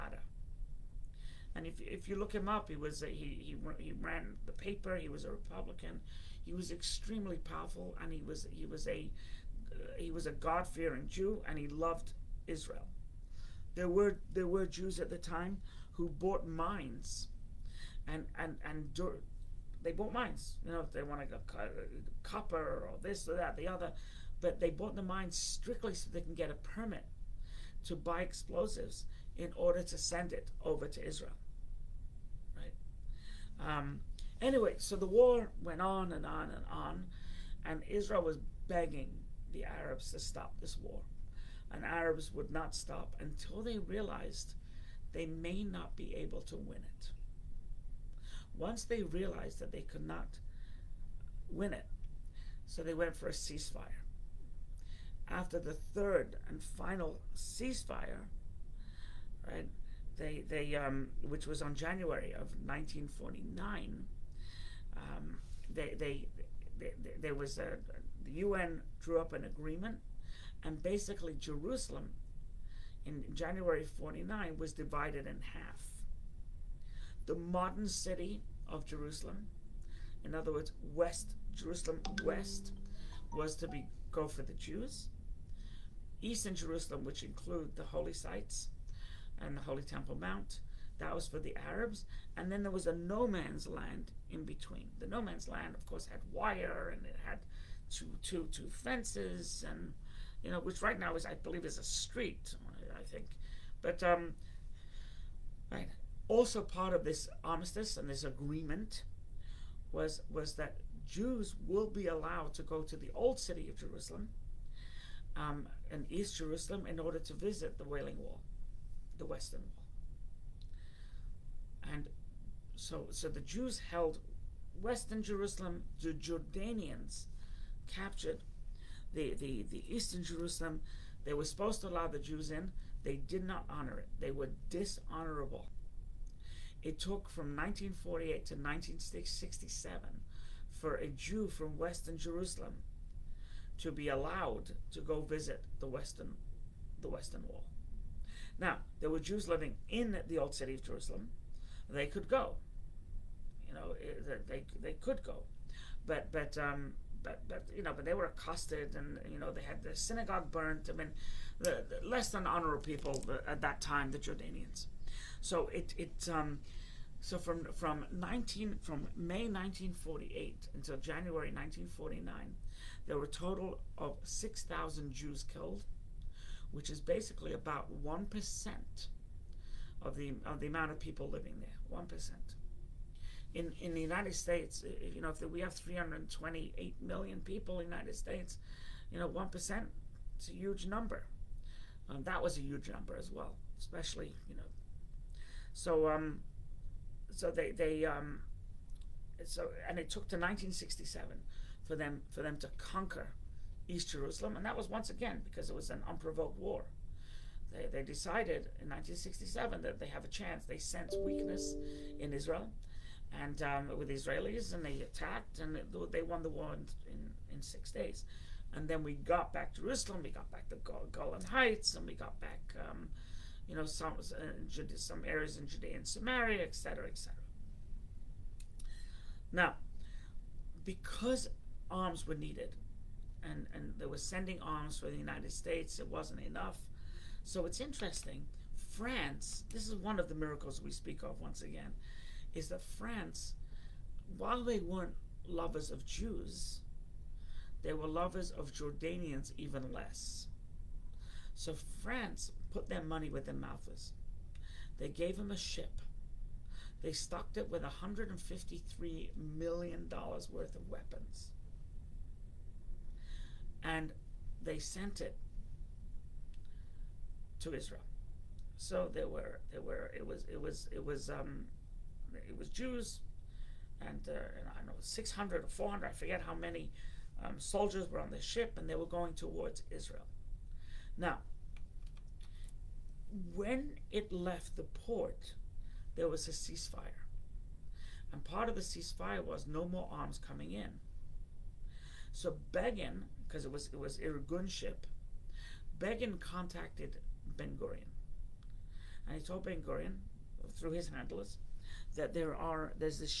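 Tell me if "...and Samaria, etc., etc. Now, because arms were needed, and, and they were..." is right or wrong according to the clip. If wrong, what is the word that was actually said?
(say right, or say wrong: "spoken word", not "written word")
right.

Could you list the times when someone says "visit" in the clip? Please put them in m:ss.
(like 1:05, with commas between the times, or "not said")
1:57, 2:25.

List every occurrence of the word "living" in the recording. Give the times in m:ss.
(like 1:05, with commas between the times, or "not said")
2:29, 3:01.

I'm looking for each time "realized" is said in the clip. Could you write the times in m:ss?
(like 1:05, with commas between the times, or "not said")
0:43, 0:49.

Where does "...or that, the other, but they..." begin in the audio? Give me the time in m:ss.
0:23.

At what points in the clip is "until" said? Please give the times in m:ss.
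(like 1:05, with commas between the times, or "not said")
0:43, 2:50.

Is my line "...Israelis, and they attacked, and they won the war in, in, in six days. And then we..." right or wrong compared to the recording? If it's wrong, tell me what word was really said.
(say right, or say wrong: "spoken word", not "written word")
right.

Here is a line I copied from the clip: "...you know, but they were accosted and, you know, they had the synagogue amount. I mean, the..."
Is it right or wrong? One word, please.
wrong.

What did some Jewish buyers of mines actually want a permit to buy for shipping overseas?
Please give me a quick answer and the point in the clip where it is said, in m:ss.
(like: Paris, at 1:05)
explosives, at 0:28.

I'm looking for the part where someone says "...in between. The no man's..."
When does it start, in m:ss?
1:34.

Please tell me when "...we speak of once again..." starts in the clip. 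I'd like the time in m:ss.
4:00.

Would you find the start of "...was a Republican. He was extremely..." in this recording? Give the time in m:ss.
0:05.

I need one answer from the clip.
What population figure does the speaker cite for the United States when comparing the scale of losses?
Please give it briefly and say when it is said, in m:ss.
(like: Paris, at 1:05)
328 million, at 3:05.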